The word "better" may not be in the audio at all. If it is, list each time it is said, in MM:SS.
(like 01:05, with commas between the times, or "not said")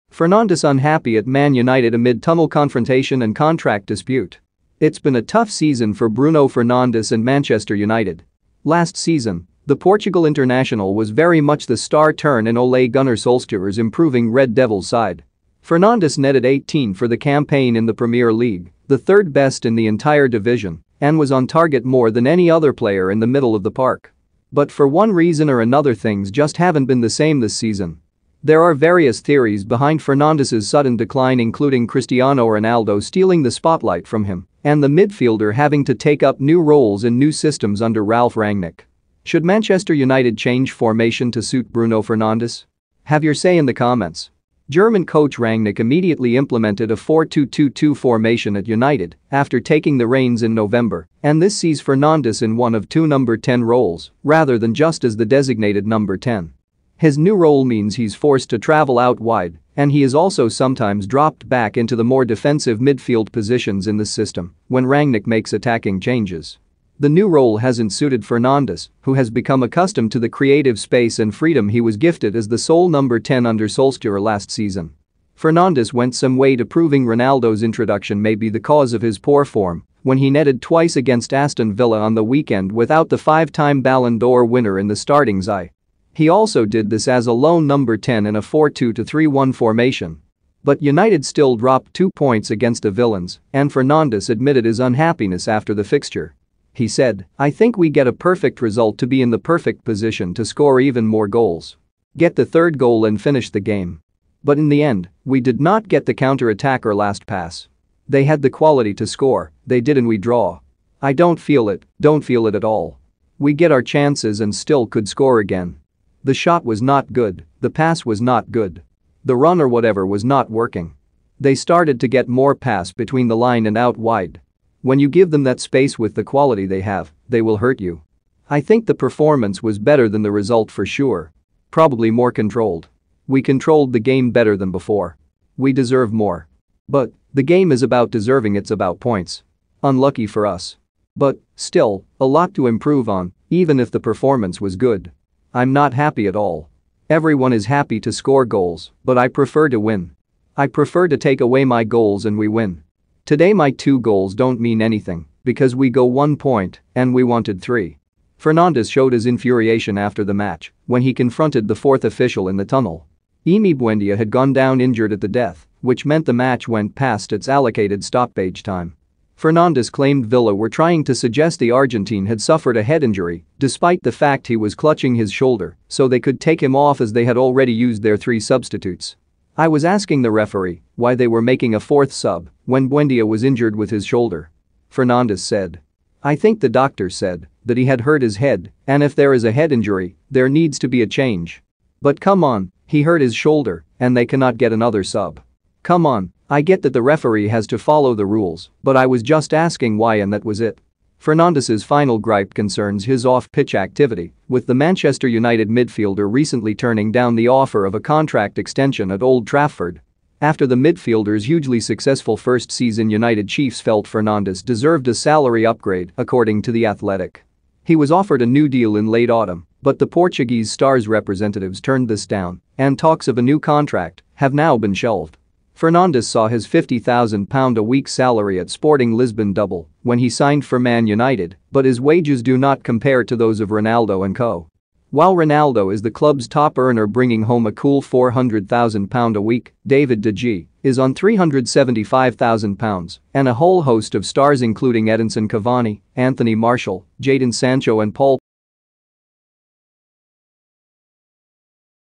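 02:09, 02:14.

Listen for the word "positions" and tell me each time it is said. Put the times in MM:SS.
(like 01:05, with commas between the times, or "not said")
01:03, 01:39.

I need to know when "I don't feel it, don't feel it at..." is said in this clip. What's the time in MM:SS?
01:51.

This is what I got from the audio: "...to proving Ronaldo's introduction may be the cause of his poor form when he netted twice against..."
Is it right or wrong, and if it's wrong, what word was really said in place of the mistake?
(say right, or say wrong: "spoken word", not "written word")
right.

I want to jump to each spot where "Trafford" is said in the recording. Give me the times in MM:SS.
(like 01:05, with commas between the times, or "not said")
03:29.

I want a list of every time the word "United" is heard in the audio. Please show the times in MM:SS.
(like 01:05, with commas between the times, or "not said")
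00:01, 00:07, 00:39, 00:48, 01:30, 03:25, 03:33, 03:51.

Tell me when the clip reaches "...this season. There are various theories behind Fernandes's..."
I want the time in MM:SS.
00:27.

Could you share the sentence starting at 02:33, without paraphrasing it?
Today my two goals don't mean anything because we go one point and we wanted three.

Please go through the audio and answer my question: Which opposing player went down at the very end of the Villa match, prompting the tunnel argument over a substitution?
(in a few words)
Emi Buendia.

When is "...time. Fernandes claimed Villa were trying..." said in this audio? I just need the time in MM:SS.
02:48.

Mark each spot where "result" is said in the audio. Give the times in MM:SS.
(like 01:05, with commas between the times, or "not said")
01:38, 02:10.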